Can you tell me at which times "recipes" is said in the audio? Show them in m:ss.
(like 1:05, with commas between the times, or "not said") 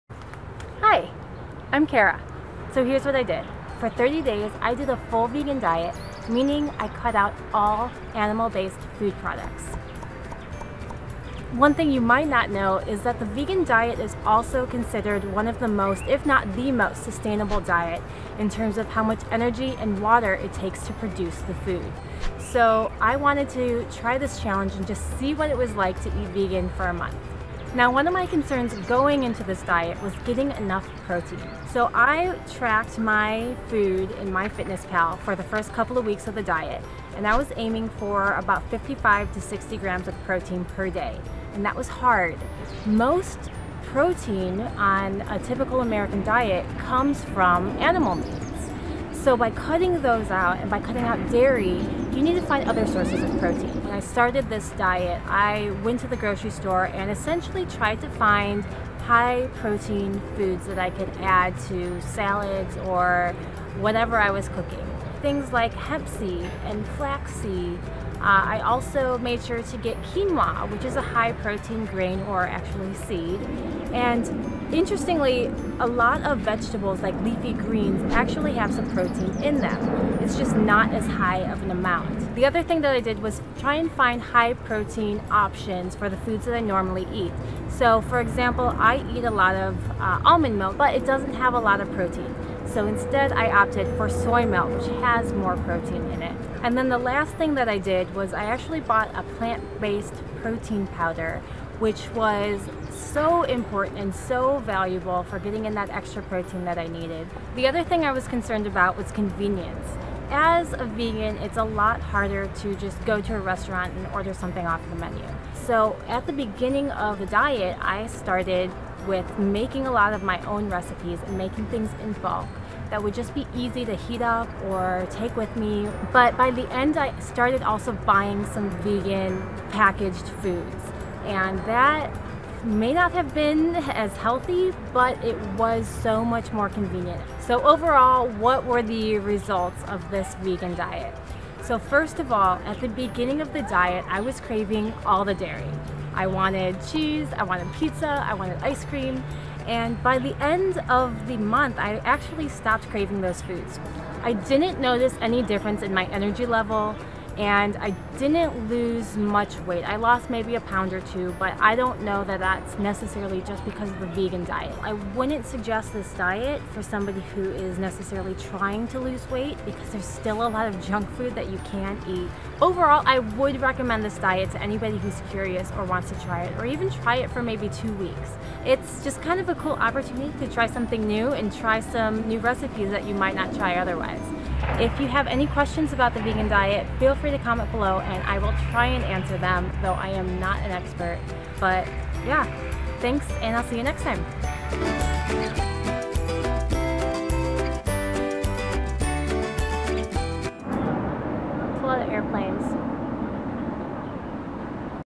2:00, 3:02.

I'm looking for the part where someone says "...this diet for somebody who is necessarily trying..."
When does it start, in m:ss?
2:45.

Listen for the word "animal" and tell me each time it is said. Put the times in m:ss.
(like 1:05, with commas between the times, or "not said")
0:08, 0:47.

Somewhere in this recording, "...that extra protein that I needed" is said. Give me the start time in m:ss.
1:45.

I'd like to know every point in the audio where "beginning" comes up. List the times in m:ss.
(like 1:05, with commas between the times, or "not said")
1:56, 2:22.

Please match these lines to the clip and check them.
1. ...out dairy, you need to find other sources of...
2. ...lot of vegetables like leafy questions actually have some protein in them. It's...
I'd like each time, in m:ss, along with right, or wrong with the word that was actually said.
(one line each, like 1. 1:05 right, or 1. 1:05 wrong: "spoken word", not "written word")
1. 0:51 right
2. 1:15 wrong: "greens", not "questions".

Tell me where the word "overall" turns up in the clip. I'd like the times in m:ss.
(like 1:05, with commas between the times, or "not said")
2:17, 2:52.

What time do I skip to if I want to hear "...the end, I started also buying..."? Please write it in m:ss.
2:06.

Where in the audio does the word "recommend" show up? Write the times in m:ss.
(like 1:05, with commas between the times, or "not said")
2:53.